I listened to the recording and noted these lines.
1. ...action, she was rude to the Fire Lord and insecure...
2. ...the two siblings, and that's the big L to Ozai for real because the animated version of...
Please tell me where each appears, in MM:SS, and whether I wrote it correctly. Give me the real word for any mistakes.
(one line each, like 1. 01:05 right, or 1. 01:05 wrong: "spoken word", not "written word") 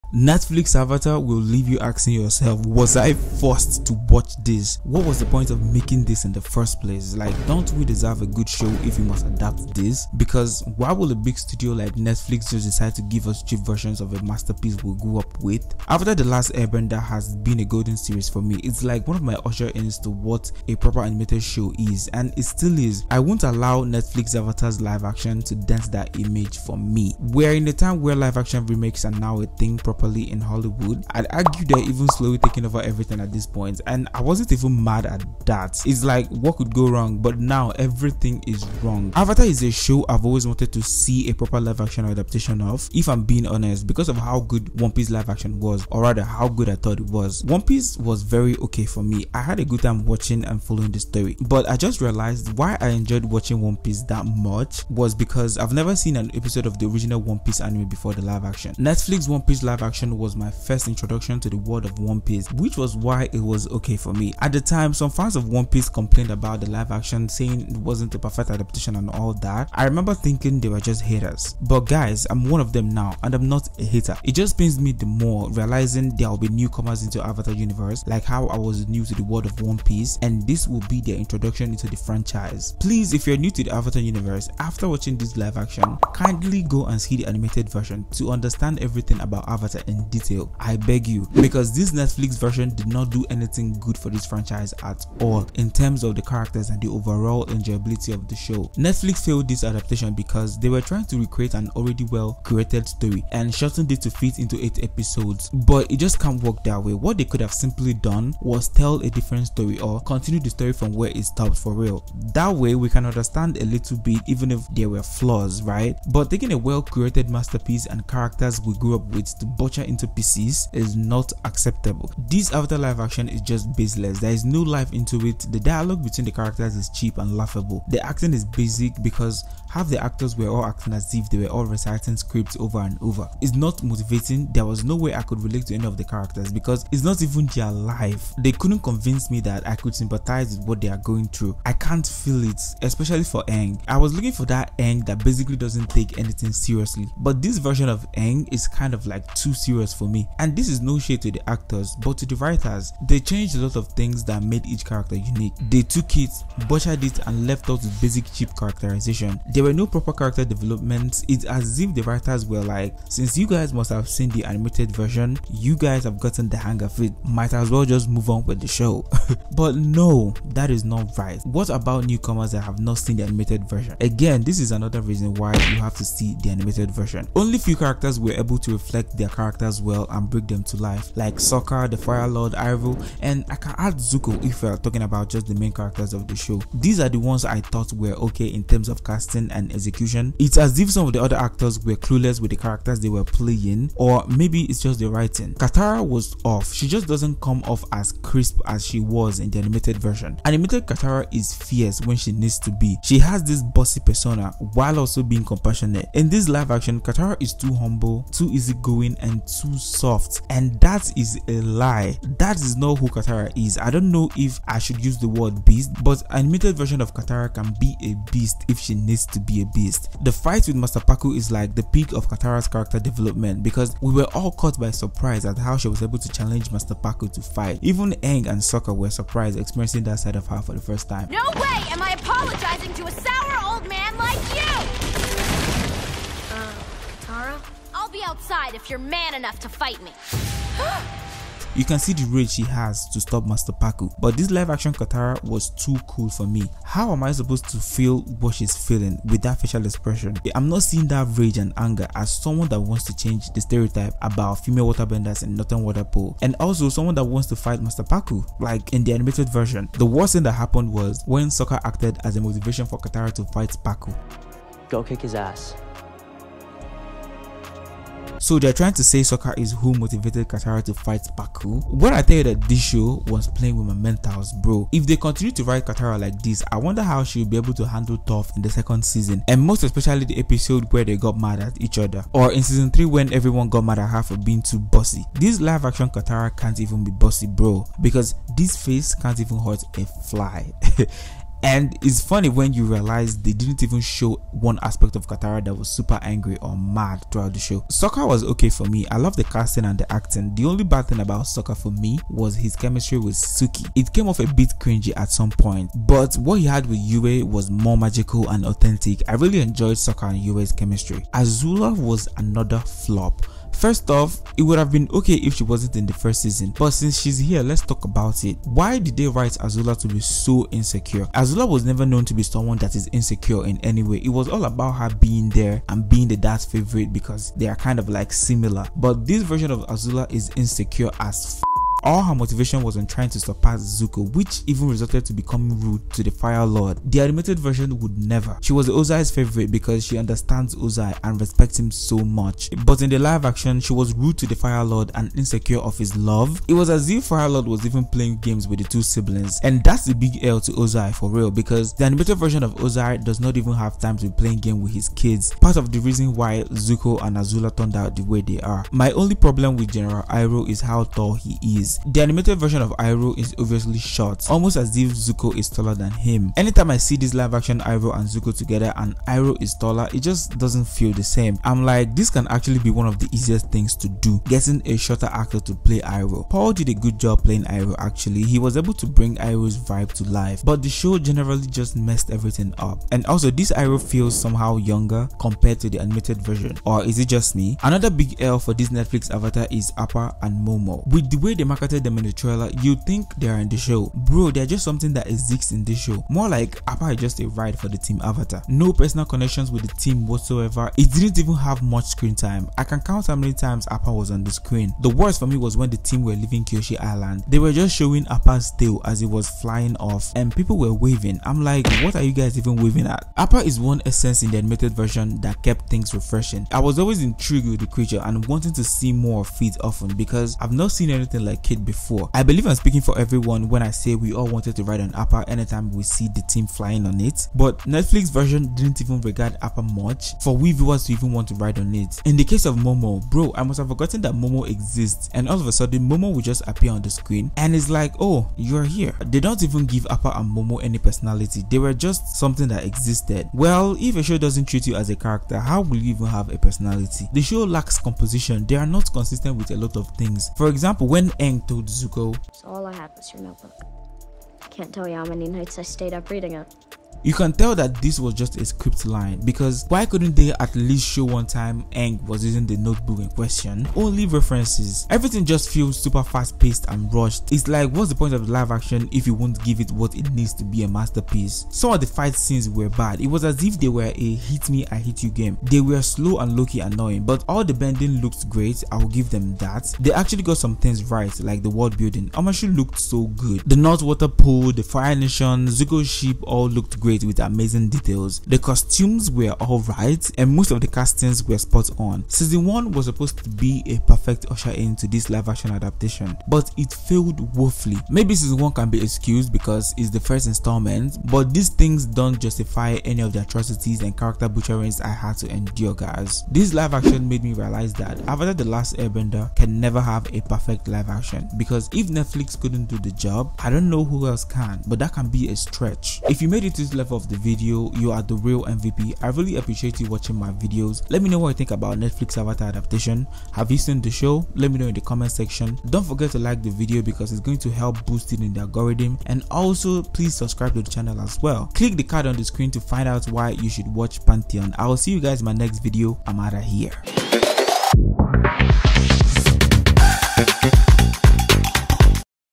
1. 05:43 right
2. 05:48 right.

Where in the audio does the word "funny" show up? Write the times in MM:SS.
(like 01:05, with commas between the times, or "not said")
04:52.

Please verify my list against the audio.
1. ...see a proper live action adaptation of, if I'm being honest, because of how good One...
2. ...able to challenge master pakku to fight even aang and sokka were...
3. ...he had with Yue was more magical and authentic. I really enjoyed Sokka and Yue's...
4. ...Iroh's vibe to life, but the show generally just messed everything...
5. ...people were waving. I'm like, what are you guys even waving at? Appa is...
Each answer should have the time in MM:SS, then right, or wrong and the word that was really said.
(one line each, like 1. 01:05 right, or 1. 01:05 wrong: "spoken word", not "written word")
1. 00:40 right
2. 03:46 right
3. 05:06 right
4. 06:19 right
5. 06:50 right.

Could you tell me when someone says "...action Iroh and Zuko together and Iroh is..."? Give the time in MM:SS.
06:07.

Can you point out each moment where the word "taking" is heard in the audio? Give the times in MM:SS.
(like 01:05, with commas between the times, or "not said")
00:32, 01:56.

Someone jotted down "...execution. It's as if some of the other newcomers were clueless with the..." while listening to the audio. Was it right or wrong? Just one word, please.
wrong.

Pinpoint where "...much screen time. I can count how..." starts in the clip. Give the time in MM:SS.
06:41.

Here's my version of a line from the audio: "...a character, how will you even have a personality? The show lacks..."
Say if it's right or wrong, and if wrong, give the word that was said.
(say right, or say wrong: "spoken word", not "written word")
right.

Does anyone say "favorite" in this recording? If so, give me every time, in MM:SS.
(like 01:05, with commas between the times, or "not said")
05:26, 05:39.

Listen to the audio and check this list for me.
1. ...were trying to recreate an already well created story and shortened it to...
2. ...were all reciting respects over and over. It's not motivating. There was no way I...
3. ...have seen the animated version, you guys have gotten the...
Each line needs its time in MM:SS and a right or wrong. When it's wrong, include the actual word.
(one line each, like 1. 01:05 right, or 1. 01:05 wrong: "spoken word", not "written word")
1. 01:40 right
2. 02:11 wrong: "scripts", not "respects"
3. 02:43 right.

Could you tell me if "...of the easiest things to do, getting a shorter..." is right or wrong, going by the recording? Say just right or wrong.
right.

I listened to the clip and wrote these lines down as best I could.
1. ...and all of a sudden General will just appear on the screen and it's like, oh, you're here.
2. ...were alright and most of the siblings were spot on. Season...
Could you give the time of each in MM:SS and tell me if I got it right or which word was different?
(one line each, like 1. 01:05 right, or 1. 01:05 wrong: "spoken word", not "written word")
1. 07:15 wrong: "Momo", not "General"
2. 08:09 wrong: "castings", not "siblings".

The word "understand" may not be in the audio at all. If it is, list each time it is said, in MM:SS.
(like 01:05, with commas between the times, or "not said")
01:28, 01:53, 05:40.